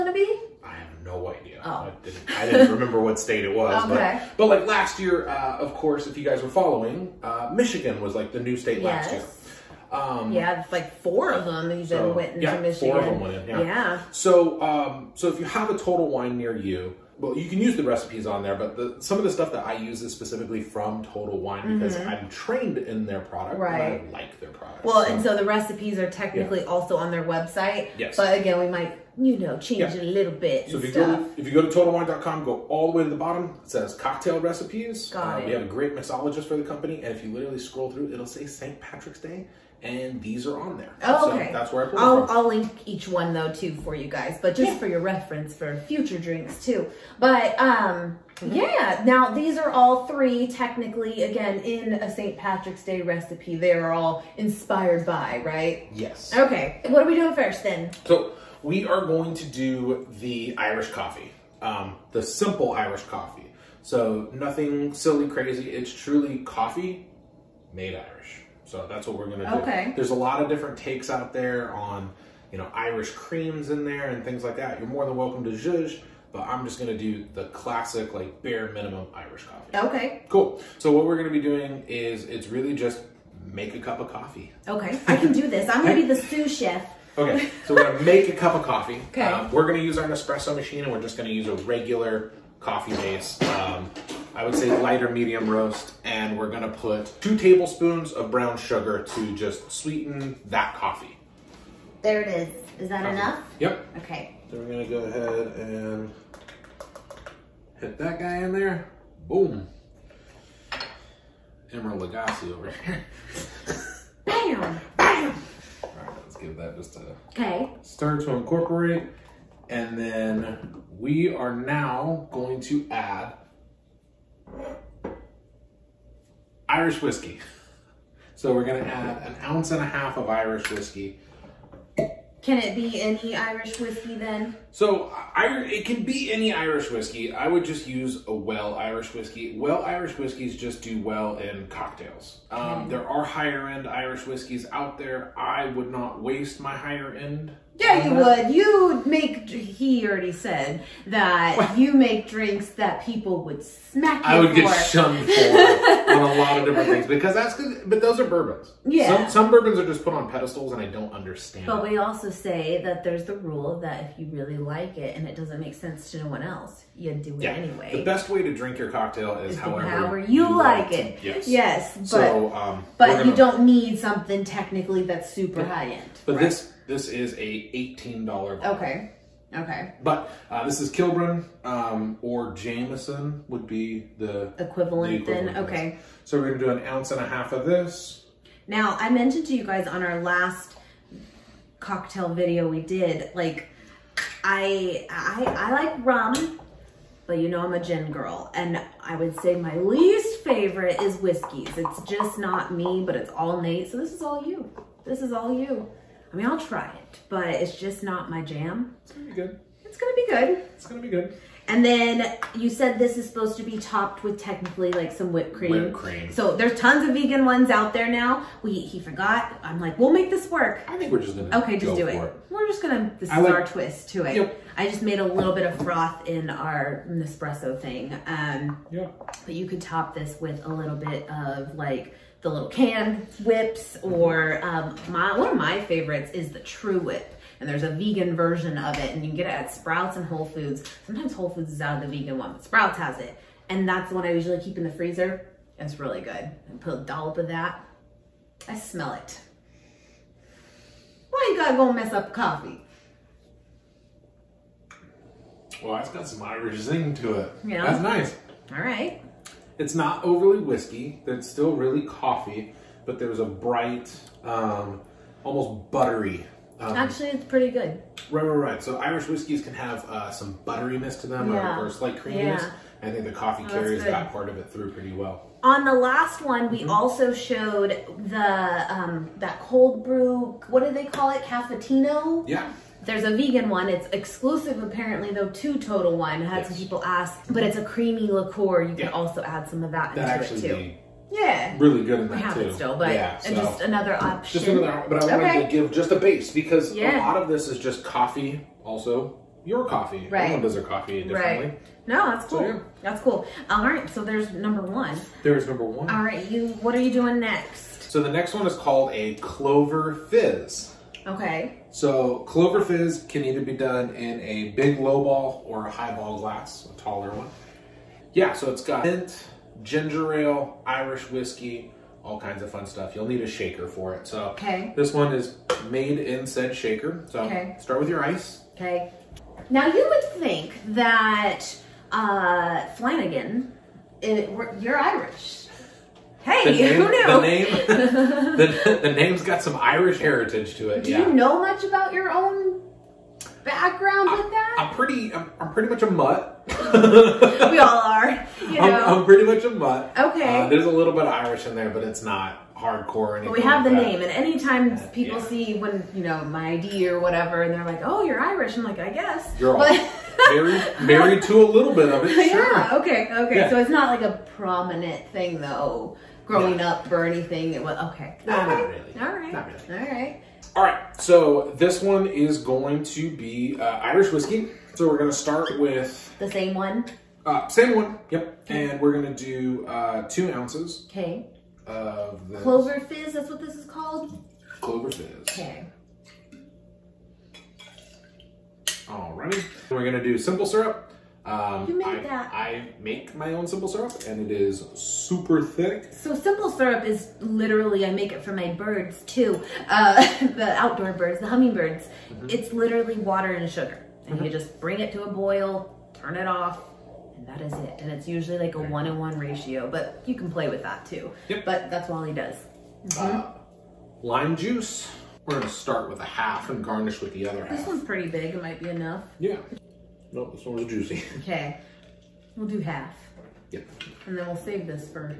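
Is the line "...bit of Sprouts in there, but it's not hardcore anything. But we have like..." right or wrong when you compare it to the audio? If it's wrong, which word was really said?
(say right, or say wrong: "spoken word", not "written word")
wrong: "Irish", not "Sprouts".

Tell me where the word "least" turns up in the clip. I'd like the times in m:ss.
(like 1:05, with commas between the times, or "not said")
3:19.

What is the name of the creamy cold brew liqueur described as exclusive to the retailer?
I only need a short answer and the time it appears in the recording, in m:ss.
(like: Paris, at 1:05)
Cafetino, at 4:41.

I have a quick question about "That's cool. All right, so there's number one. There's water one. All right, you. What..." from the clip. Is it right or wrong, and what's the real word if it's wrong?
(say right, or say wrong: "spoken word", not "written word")
wrong: "number", not "water".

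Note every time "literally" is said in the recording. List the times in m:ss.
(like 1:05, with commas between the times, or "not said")
0:37, 6:37, 6:42.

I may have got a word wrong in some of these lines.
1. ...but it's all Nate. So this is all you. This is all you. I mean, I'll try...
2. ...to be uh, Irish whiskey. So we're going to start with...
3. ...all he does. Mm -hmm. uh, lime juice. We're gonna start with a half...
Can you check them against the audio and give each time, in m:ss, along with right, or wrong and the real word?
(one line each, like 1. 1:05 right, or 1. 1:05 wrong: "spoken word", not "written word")
1. 3:23 right
2. 6:13 right
3. 6:52 right.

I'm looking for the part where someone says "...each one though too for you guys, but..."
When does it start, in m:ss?
0:42.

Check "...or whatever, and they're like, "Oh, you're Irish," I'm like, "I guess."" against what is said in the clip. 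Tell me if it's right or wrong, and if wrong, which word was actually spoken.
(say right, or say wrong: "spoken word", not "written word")
right.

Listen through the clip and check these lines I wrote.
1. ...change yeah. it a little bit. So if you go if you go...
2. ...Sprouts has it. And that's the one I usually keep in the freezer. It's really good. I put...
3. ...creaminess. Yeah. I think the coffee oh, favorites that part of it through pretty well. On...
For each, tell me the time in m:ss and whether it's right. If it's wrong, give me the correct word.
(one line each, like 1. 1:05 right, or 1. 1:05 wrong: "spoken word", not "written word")
1. 0:29 right
2. 4:02 right
3. 4:32 wrong: "carries", not "favorites".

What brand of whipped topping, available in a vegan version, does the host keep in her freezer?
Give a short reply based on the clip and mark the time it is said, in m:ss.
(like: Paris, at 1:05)
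TruWhip, at 3:56.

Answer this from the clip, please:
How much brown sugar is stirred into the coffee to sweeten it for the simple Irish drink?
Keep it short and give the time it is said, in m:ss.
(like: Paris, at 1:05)
2 tablespoons, at 1:37.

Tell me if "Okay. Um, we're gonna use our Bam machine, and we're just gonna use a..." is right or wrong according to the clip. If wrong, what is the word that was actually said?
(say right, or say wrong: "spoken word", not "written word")
wrong: "Nespresso", not "Bam".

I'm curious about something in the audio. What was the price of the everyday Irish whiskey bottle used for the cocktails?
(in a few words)
$18.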